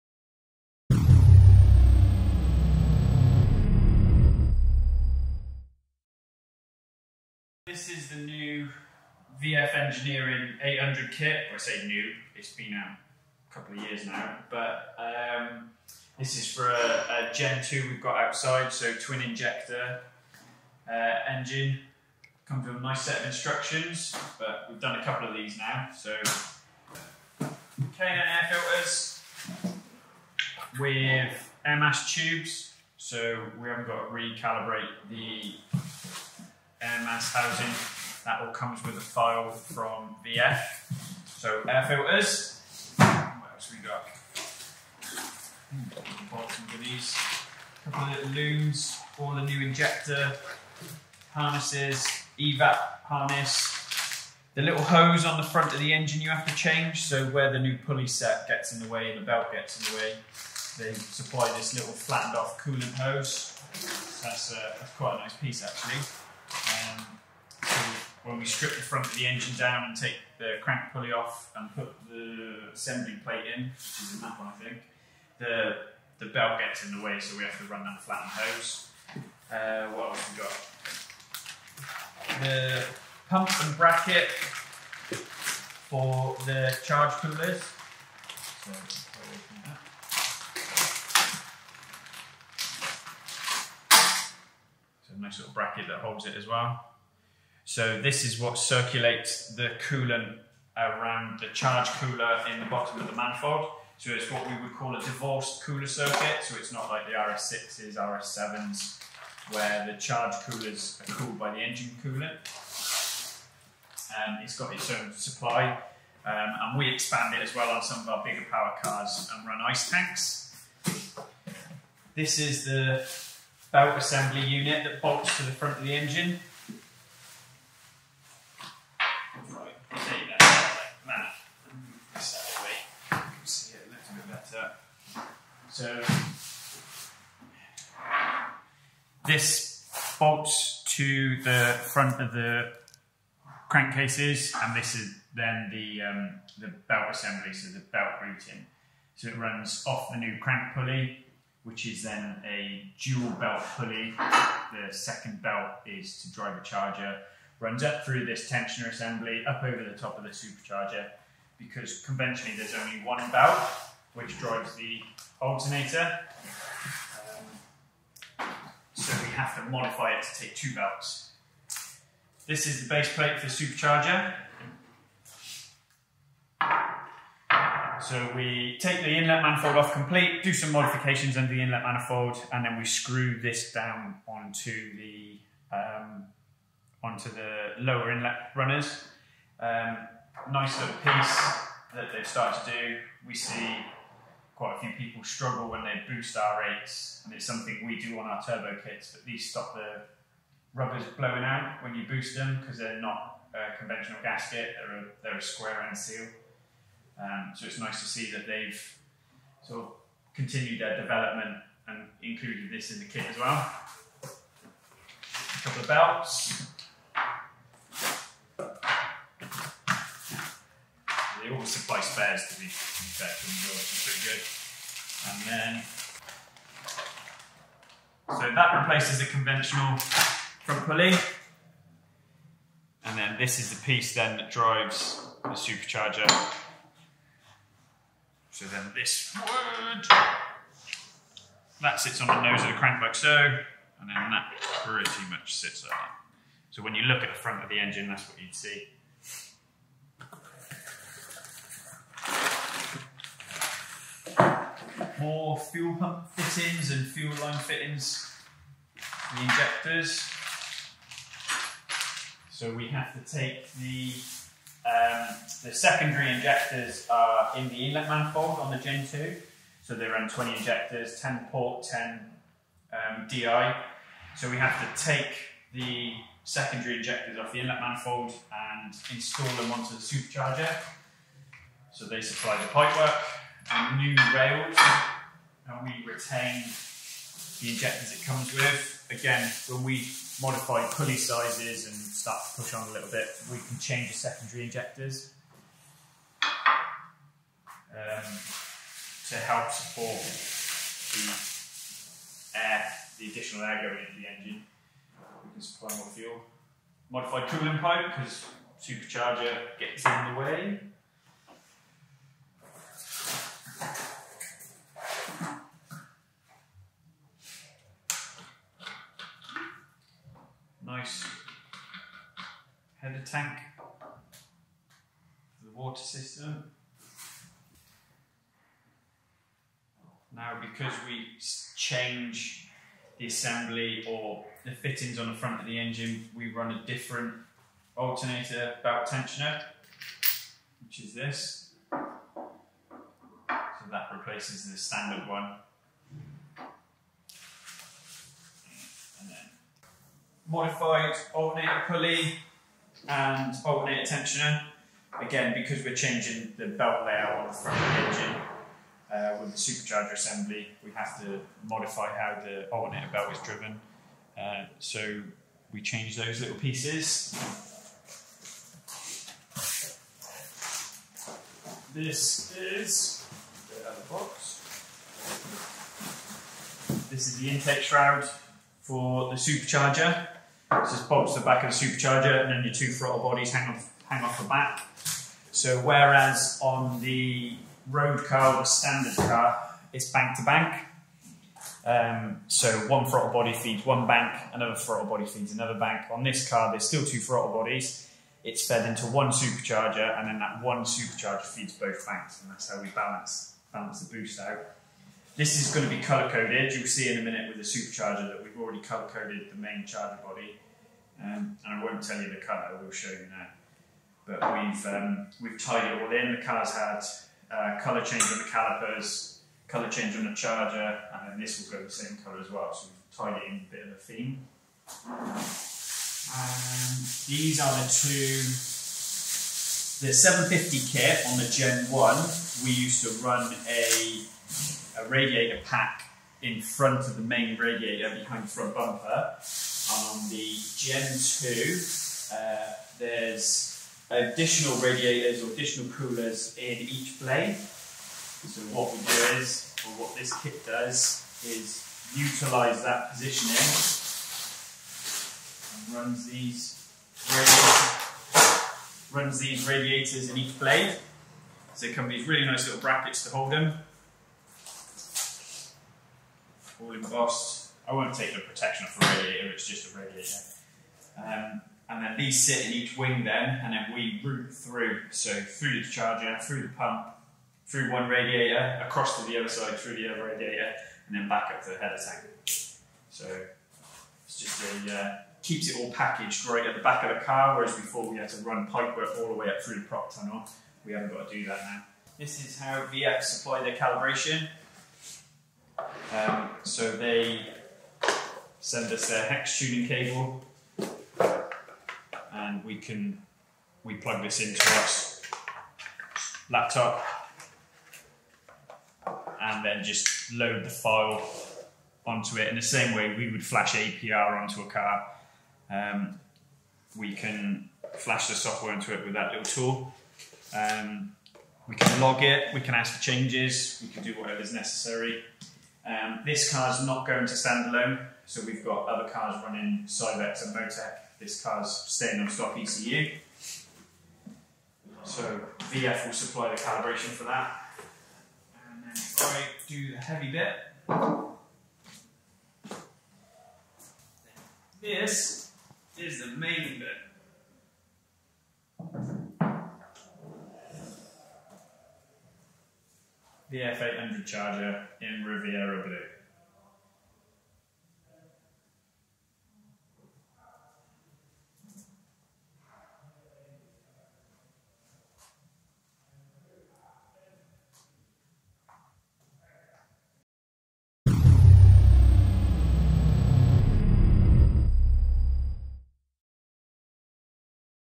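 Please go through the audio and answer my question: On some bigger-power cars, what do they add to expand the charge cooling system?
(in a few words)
ice tanks.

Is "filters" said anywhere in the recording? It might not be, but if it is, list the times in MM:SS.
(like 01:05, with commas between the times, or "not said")
00:28, 00:41.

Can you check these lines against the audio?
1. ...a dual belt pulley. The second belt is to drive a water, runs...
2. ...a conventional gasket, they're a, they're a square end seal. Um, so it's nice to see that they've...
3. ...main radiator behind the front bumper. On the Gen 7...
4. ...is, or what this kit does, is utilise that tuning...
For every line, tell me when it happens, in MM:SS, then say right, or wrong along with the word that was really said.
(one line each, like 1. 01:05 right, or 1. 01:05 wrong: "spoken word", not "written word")
1. 02:32 wrong: "charger", not "water"
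2. 03:23 right
3. 07:17 wrong: "2", not "7"
4. 07:29 wrong: "positioning", not "tuning".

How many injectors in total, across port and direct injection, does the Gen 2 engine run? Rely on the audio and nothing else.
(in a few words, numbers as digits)
20.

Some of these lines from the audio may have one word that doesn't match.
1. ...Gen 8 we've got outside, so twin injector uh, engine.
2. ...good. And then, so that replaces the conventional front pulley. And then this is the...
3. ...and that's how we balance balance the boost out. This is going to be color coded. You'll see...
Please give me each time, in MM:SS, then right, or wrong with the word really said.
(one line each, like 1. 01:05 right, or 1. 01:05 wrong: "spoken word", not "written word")
1. 00:17 wrong: "2", not "8"
2. 03:45 right
3. 06:42 right.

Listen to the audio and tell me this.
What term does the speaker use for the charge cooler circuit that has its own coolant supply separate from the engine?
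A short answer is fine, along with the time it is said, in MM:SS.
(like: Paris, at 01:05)
divorced cooler circuit, at 01:44.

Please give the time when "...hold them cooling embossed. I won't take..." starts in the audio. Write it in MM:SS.
07:43.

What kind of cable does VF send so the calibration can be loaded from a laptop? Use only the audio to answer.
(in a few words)
hex tuning cable.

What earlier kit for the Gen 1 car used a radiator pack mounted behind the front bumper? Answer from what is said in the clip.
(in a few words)
the 750 kit.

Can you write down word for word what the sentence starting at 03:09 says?
Um, nice little piece that they've started to do.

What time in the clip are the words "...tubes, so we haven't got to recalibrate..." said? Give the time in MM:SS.
00:32.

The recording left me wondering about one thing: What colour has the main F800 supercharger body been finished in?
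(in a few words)
Riviera Blue.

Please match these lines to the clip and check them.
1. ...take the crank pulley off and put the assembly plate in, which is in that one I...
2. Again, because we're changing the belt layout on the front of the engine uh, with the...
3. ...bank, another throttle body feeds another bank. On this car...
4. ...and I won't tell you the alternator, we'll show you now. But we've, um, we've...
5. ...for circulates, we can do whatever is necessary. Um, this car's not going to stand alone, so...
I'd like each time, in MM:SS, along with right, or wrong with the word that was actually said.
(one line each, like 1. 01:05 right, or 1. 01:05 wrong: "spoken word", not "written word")
1. 01:09 right
2. 05:55 right
3. 06:34 right
4. 06:51 wrong: "color", not "alternator"
5. 08:42 wrong: "changes", not "circulates".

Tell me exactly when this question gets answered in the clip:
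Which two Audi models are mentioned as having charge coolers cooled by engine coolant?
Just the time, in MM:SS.
01:47.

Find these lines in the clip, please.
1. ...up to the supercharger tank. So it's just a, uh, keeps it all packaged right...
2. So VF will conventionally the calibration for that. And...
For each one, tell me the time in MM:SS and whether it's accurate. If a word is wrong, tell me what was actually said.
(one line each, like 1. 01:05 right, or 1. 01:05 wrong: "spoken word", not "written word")
1. 08:01 wrong: "header", not "supercharger"
2. 08:55 wrong: "supply", not "conventionally".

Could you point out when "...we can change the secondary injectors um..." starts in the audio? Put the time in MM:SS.
04:53.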